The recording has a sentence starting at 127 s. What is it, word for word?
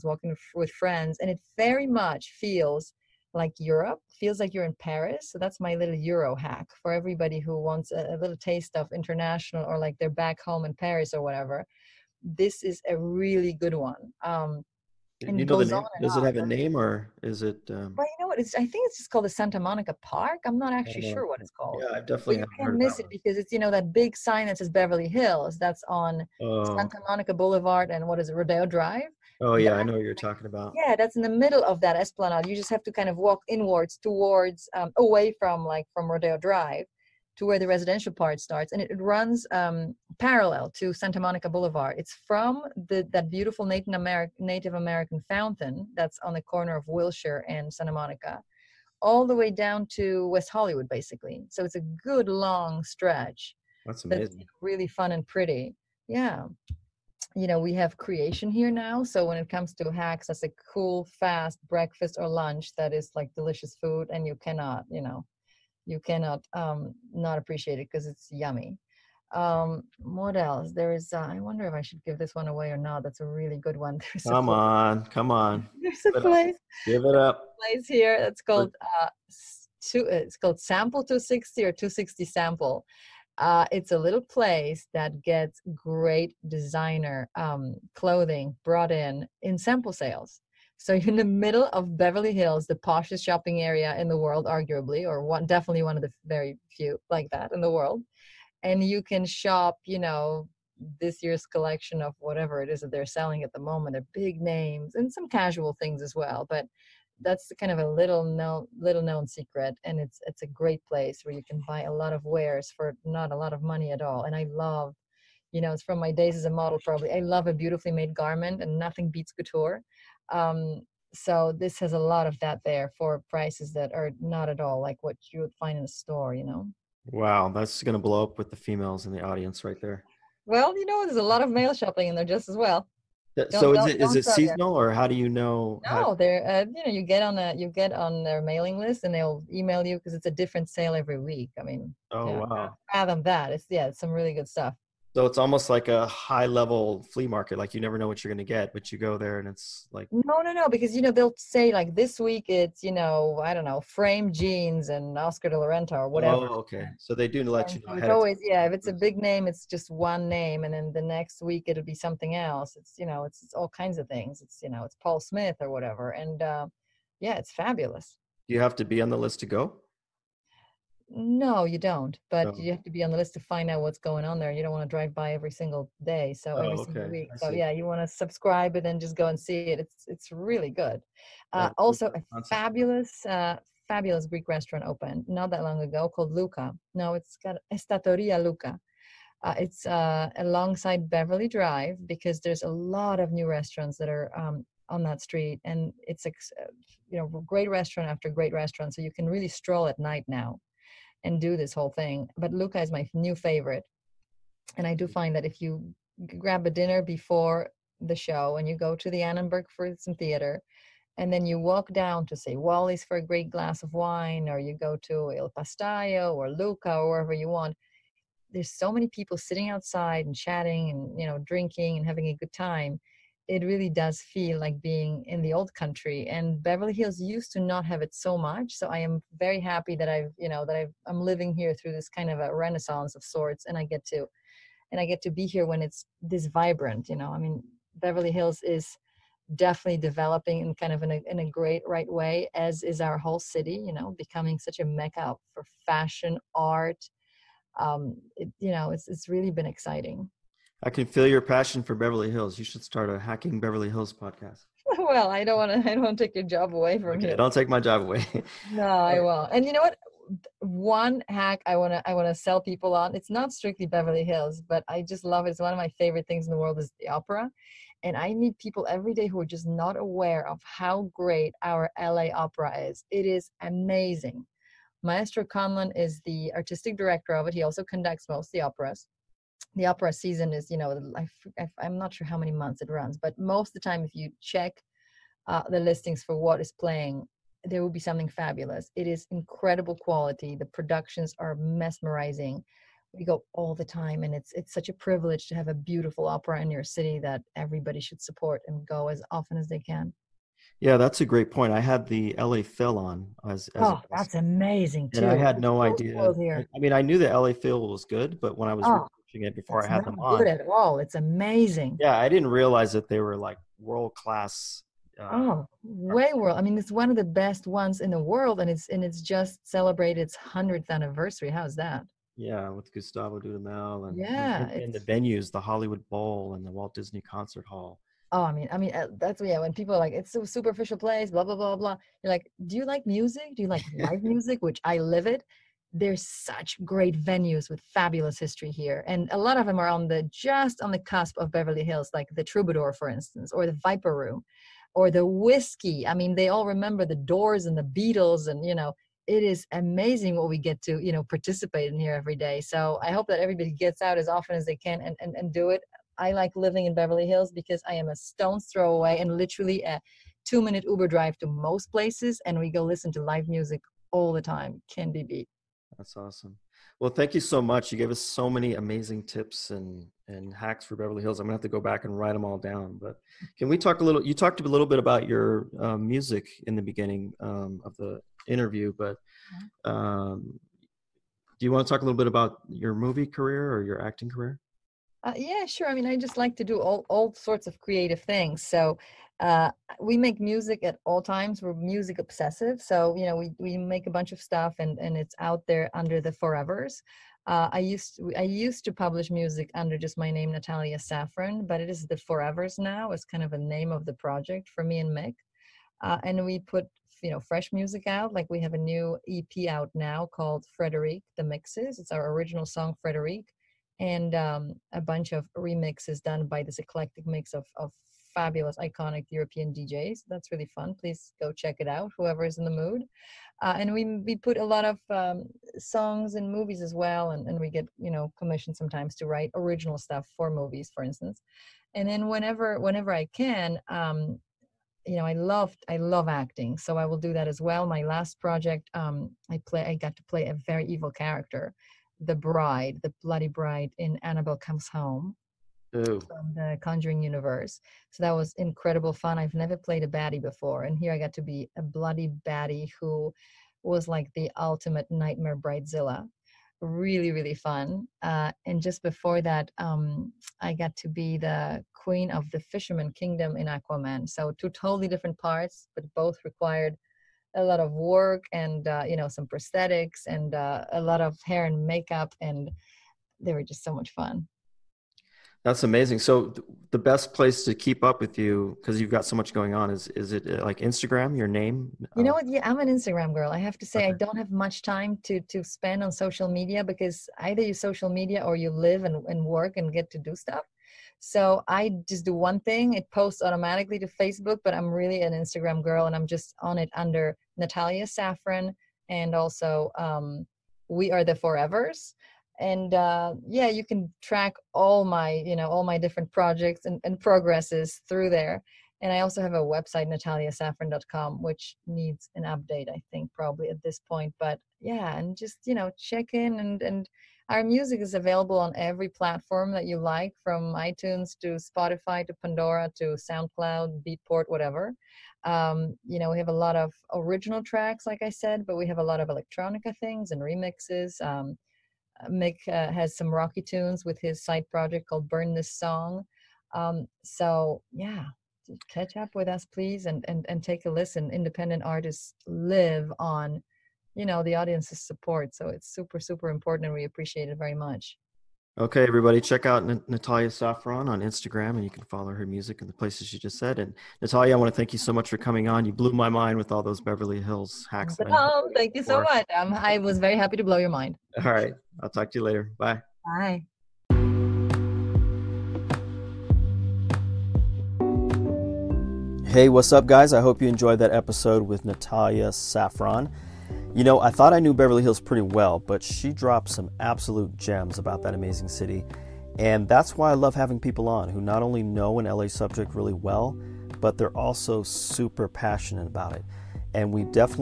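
Wow, that's gonna blow up with the females in the audience right there.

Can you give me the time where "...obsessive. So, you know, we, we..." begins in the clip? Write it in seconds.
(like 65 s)
392 s.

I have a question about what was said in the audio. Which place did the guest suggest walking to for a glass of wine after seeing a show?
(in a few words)
Wally's.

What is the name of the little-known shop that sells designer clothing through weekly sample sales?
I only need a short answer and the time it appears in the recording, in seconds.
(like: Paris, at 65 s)
Sample 260, at 80 s.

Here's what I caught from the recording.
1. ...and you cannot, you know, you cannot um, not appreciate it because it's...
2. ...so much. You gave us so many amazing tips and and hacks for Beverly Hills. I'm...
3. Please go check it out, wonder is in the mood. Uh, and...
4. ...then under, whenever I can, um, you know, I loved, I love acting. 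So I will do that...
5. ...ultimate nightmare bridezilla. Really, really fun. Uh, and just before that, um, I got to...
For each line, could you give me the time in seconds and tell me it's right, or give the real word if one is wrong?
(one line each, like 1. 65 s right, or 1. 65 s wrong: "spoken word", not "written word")
1. 64 s right
2. 367 s right
3. 420 s wrong: "whoever", not "wonder"
4. 432 s wrong: "whenever", not "under"
5. 454 s right.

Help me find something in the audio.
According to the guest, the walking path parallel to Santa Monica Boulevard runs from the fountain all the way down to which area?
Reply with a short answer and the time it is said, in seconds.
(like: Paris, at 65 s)
West Hollywood, at 50 s.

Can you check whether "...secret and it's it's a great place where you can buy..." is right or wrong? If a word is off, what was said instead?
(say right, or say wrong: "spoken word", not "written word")
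right.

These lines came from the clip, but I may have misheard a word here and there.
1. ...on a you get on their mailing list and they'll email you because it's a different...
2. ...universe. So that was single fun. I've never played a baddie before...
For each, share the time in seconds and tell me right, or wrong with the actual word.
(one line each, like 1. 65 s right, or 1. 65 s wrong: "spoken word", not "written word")
1. 137 s right
2. 447 s wrong: "incredible", not "single".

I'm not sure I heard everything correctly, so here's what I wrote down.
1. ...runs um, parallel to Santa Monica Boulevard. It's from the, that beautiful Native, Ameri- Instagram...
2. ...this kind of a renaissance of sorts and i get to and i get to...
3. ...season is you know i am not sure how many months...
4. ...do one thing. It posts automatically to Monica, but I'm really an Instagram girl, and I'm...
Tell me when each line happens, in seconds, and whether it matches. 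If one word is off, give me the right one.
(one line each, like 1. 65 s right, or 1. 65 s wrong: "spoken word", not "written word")
1. 38 s wrong: "Native", not "Instagram"
2. 231 s right
3. 280 s right
4. 492 s wrong: "Facebook", not "Monica".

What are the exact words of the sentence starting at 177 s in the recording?
So yeah, you want to subscribe and then just go and see it.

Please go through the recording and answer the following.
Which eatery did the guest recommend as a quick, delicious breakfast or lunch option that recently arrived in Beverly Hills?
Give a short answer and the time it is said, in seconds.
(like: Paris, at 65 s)
Kreation, at 57 s.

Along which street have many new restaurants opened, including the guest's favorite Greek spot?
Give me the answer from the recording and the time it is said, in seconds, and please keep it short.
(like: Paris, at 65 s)
Beverly Drive, at 191 s.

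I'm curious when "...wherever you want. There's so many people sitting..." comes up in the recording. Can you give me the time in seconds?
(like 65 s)
217 s.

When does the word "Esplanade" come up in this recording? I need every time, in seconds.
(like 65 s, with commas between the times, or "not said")
31 s.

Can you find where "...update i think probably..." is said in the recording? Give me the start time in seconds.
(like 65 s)
512 s.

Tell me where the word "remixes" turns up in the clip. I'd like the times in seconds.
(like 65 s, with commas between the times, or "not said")
415 s, 530 s.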